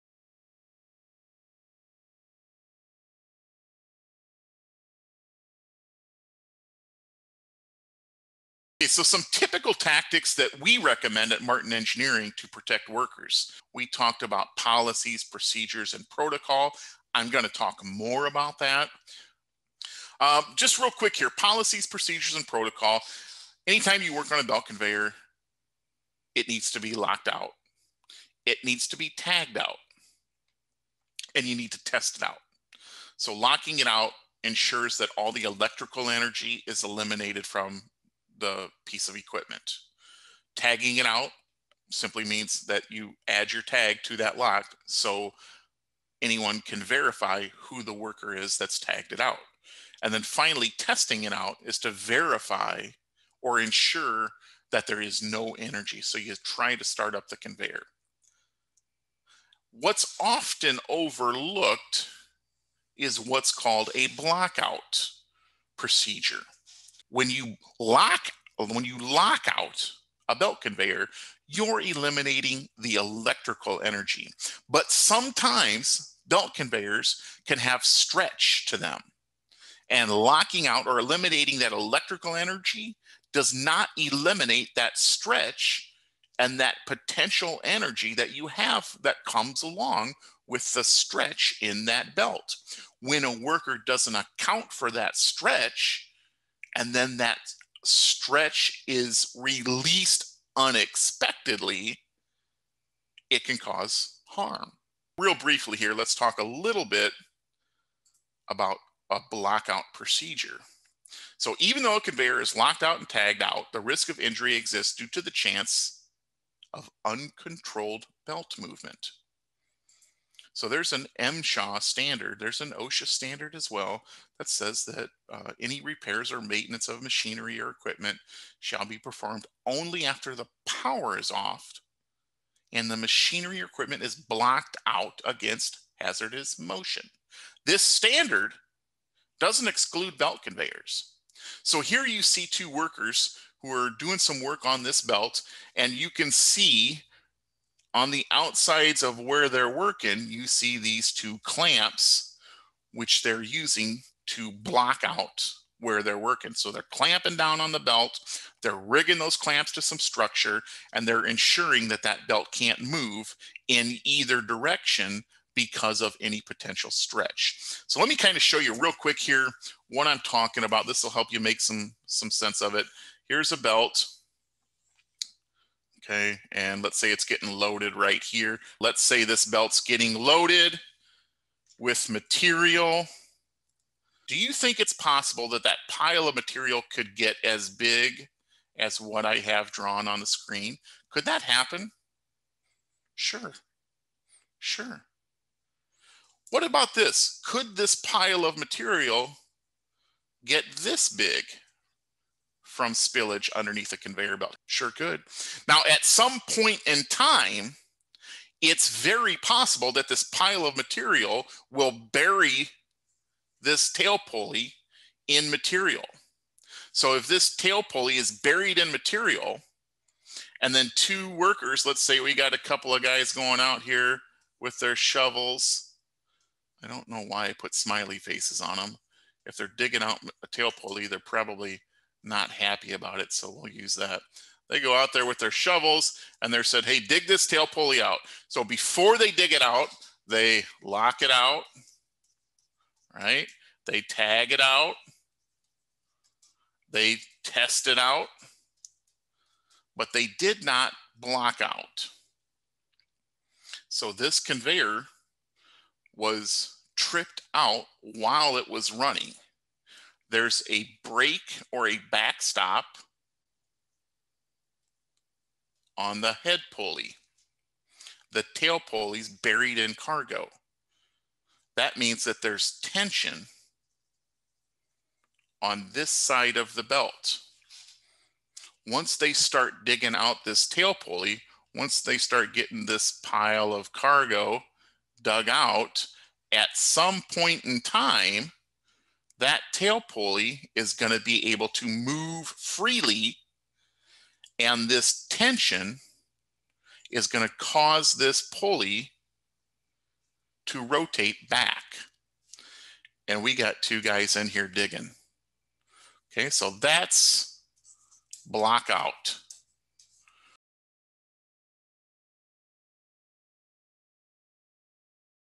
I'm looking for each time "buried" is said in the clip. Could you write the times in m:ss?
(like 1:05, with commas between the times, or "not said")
3:38, 4:29.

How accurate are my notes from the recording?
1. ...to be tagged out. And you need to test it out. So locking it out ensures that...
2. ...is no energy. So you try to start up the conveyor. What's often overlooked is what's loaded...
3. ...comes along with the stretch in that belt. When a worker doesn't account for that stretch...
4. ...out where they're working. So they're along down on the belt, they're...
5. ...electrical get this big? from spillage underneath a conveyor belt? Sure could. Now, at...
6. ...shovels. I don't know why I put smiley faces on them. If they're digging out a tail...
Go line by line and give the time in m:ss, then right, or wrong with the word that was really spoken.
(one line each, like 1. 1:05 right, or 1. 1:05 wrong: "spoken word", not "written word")
1. 0:28 right
2. 0:55 wrong: "called", not "loaded"
3. 1:29 right
4. 2:35 wrong: "clamping", not "along"
5. 3:18 wrong: "material", not "electrical"
6. 3:44 right.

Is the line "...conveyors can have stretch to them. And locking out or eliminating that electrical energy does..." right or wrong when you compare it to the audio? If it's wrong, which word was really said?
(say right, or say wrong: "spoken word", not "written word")
right.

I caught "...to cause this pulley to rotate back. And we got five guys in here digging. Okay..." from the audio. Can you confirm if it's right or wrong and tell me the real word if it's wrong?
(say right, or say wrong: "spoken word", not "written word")
wrong: "two", not "five".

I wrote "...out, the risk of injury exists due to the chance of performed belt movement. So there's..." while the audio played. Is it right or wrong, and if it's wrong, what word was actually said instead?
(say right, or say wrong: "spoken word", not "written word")
wrong: "uncontrolled", not "performed".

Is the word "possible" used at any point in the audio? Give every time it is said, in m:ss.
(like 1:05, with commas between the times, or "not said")
3:04, 3:29.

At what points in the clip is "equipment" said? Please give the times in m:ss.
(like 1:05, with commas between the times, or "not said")
0:39, 2:07, 2:13.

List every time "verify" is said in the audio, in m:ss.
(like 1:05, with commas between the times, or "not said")
0:46, 0:51.